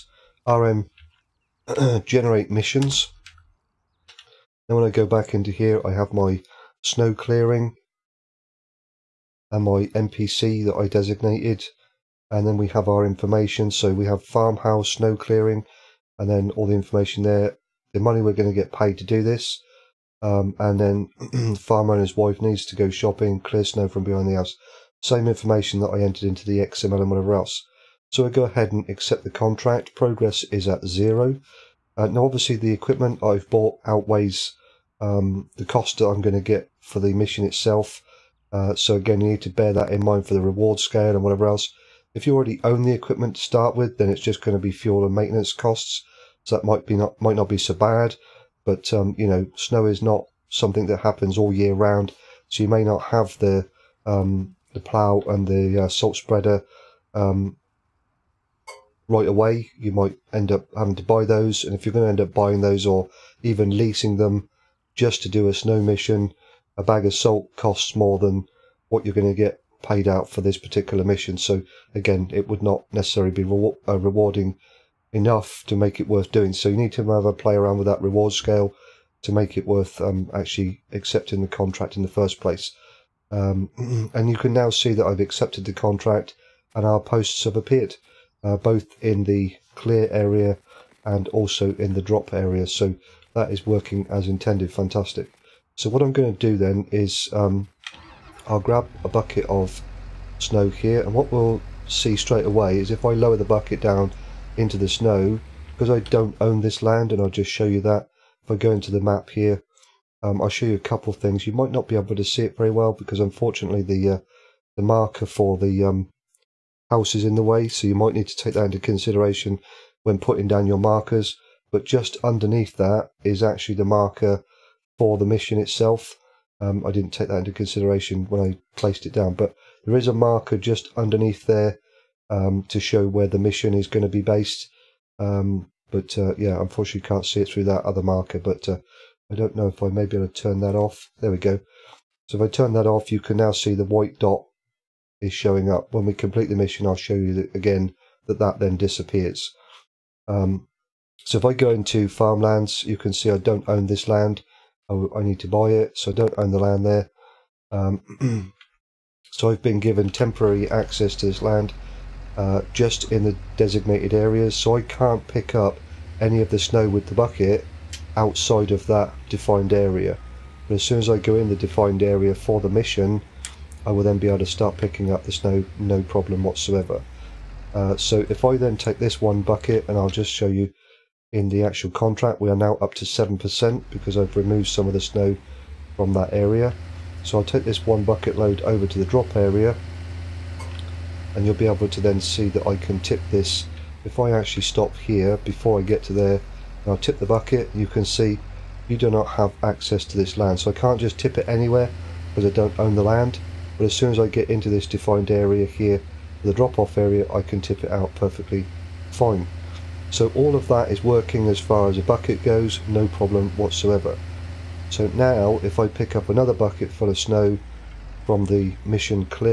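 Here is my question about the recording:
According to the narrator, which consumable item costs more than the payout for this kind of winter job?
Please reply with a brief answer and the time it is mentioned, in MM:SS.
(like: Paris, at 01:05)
A bag of salt, at 01:06.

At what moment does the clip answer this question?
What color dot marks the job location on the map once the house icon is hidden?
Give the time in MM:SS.
02:23.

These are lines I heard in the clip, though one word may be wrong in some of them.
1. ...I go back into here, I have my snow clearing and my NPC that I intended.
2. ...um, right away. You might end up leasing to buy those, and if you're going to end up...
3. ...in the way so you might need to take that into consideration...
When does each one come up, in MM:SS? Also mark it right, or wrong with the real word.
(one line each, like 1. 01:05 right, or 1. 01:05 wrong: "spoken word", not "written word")
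1. 00:04 wrong: "designated", not "intended"
2. 00:57 wrong: "having", not "leasing"
3. 01:57 right.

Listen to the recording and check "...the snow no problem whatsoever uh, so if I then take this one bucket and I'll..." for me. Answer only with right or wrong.
right.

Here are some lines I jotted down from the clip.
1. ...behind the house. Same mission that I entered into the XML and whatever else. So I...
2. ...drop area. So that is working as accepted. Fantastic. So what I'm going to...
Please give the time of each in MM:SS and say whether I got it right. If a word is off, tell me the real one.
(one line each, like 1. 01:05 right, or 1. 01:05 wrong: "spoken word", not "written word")
1. 00:24 wrong: "information", not "mission"
2. 01:32 wrong: "intended", not "accepted".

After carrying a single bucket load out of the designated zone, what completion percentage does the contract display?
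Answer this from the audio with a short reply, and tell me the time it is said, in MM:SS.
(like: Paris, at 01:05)
7%, at 03:03.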